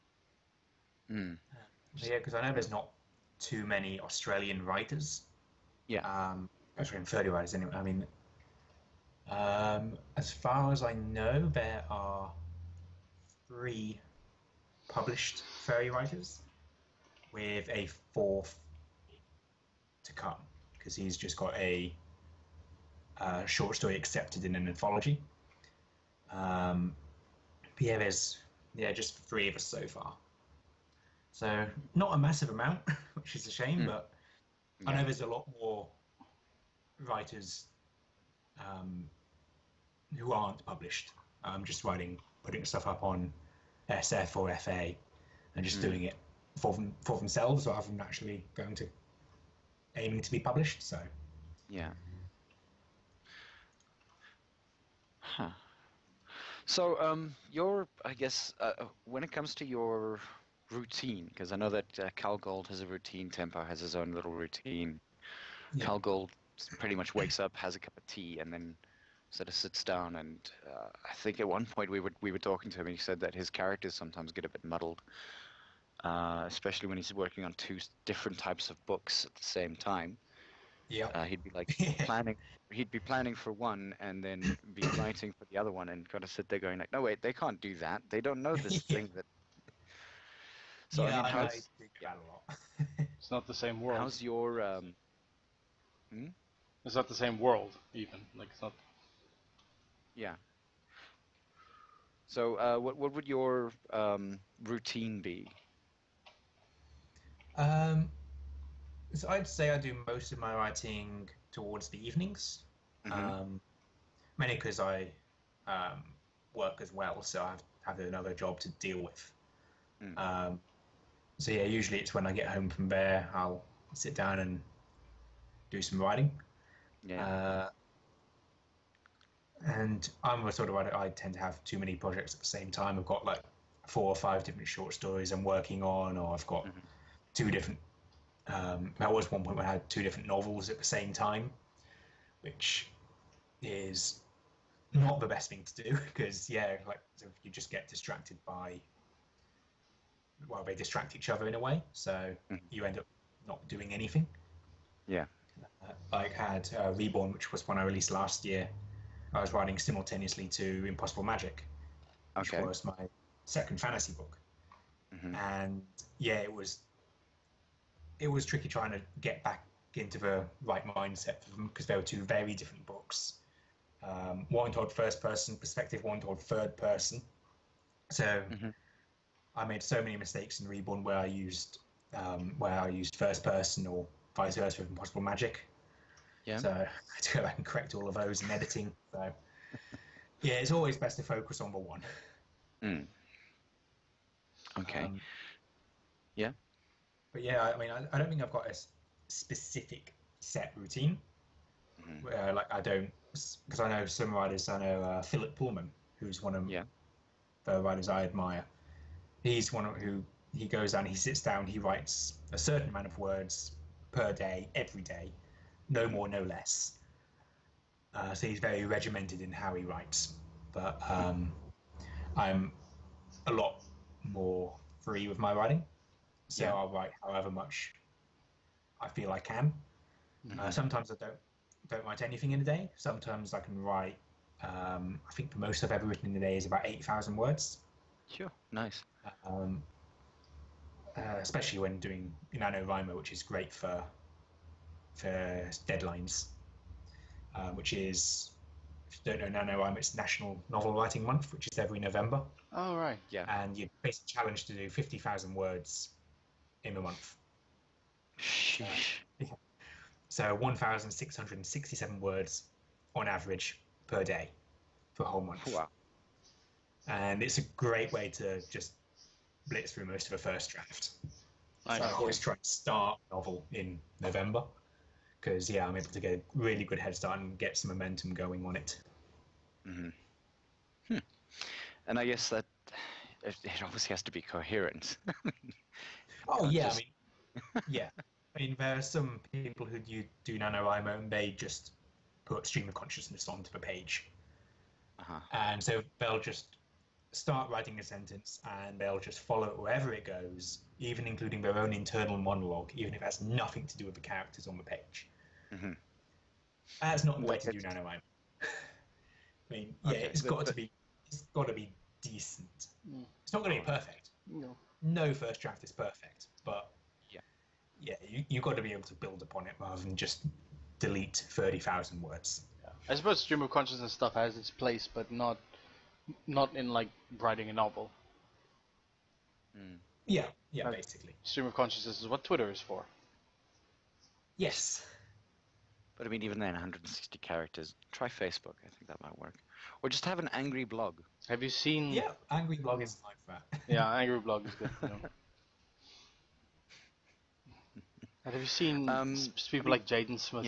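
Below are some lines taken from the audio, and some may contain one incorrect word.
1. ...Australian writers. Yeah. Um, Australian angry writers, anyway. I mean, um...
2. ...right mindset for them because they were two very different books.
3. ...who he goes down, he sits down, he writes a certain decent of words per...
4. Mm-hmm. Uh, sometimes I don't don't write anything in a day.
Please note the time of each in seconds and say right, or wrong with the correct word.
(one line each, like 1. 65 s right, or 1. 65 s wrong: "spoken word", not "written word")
1. 3 s wrong: "furry", not "angry"
2. 170 s right
3. 209 s wrong: "amount", not "decent"
4. 230 s right.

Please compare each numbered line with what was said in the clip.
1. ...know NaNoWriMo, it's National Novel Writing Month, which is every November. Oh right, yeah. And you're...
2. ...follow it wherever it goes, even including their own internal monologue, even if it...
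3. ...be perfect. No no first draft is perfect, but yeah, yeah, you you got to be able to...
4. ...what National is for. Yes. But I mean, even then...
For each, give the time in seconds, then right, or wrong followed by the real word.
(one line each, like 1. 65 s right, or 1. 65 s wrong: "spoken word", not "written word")
1. 249 s right
2. 299 s right
3. 313 s right
4. 332 s wrong: "Twitter", not "National".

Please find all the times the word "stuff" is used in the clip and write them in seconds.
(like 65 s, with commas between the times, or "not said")
42 s, 324 s.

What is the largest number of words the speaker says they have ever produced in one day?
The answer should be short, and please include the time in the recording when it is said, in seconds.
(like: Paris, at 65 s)
8000, at 236 s.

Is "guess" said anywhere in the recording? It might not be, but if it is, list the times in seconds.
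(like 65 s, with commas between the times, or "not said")
58 s, 282 s.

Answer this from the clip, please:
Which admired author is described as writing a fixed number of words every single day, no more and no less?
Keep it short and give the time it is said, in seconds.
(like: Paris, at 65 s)
Philip Pullman, at 205 s.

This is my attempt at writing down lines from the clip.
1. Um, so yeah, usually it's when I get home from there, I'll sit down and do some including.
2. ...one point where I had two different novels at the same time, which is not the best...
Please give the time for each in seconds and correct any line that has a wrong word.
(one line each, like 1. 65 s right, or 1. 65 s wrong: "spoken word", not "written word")
1. 120 s wrong: "writing", not "including"
2. 139 s right.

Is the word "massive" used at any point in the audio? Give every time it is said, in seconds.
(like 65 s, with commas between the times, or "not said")
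32 s.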